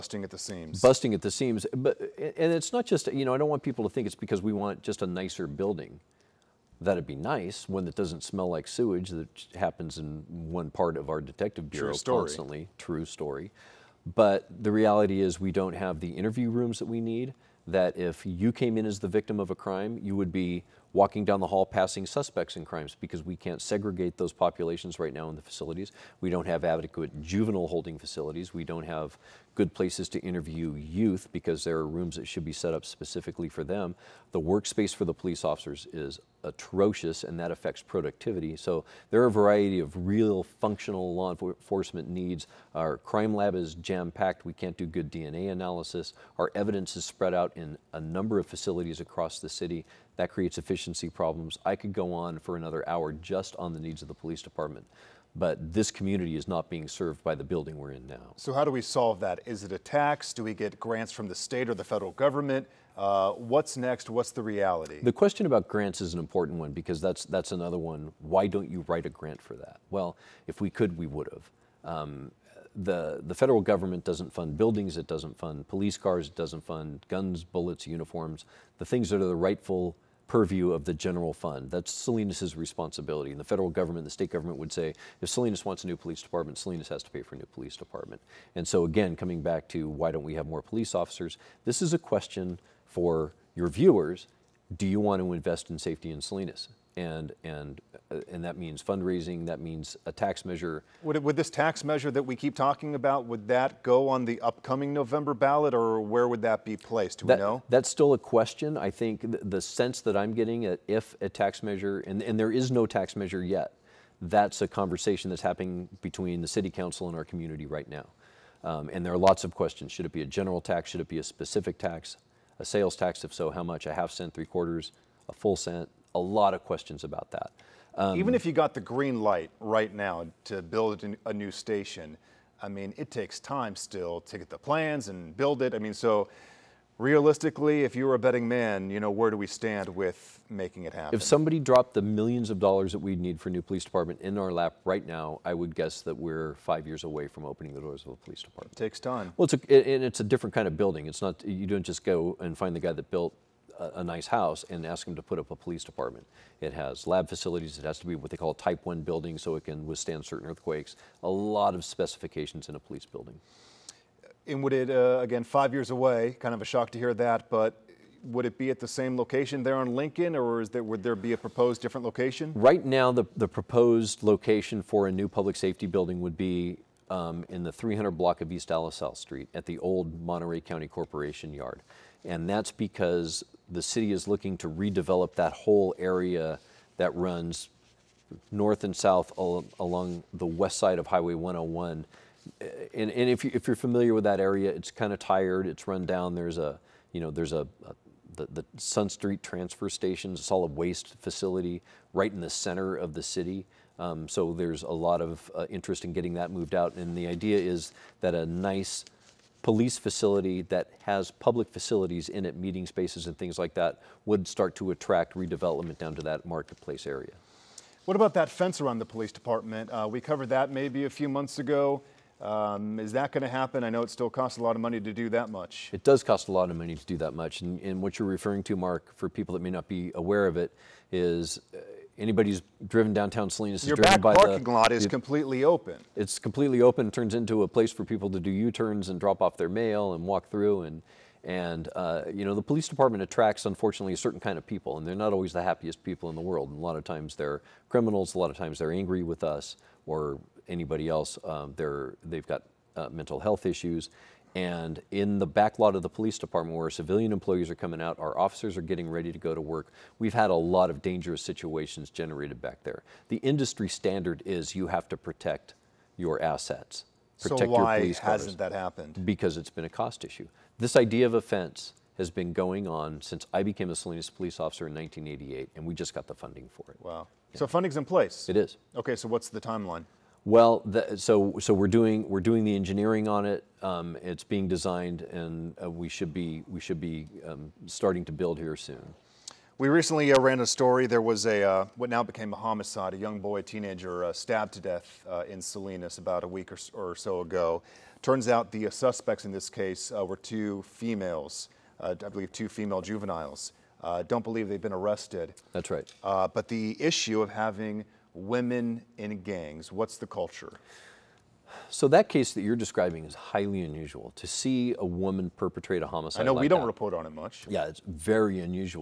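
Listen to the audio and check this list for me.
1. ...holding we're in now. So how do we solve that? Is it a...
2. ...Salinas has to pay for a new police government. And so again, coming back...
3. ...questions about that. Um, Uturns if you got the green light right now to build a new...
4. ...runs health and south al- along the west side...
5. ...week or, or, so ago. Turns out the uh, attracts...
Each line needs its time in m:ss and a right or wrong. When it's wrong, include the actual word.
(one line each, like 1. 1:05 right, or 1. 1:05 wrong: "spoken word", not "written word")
1. 0:57 wrong: "building", not "holding"
2. 1:26 wrong: "department", not "government"
3. 2:06 wrong: "Even", not "Uturns"
4. 3:07 wrong: "north", not "health"
5. 4:56 wrong: "suspects", not "attracts".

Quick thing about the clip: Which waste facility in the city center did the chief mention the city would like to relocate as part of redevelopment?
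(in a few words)
Sun Street Transfer Station.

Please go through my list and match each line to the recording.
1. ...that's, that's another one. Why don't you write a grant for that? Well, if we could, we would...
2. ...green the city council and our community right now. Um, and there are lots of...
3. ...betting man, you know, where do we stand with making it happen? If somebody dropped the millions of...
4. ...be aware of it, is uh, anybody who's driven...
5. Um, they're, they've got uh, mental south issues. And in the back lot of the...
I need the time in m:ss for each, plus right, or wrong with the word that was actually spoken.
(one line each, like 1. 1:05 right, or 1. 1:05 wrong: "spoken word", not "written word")
1. 1:06 right
2. 1:56 wrong: "between", not "green"
3. 2:18 right
4. 3:49 right
5. 4:11 wrong: "health", not "south".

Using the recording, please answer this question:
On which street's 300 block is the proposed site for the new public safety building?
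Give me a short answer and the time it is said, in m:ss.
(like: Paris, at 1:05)
East Alisal Street, at 2:58.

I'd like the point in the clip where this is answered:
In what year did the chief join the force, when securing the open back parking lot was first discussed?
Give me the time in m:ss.
4:34.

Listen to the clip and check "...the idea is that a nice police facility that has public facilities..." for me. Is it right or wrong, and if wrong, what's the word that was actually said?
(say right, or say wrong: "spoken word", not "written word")
right.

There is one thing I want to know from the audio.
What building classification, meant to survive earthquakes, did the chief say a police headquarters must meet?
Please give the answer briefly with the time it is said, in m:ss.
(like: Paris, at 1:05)
Type 1, at 2:38.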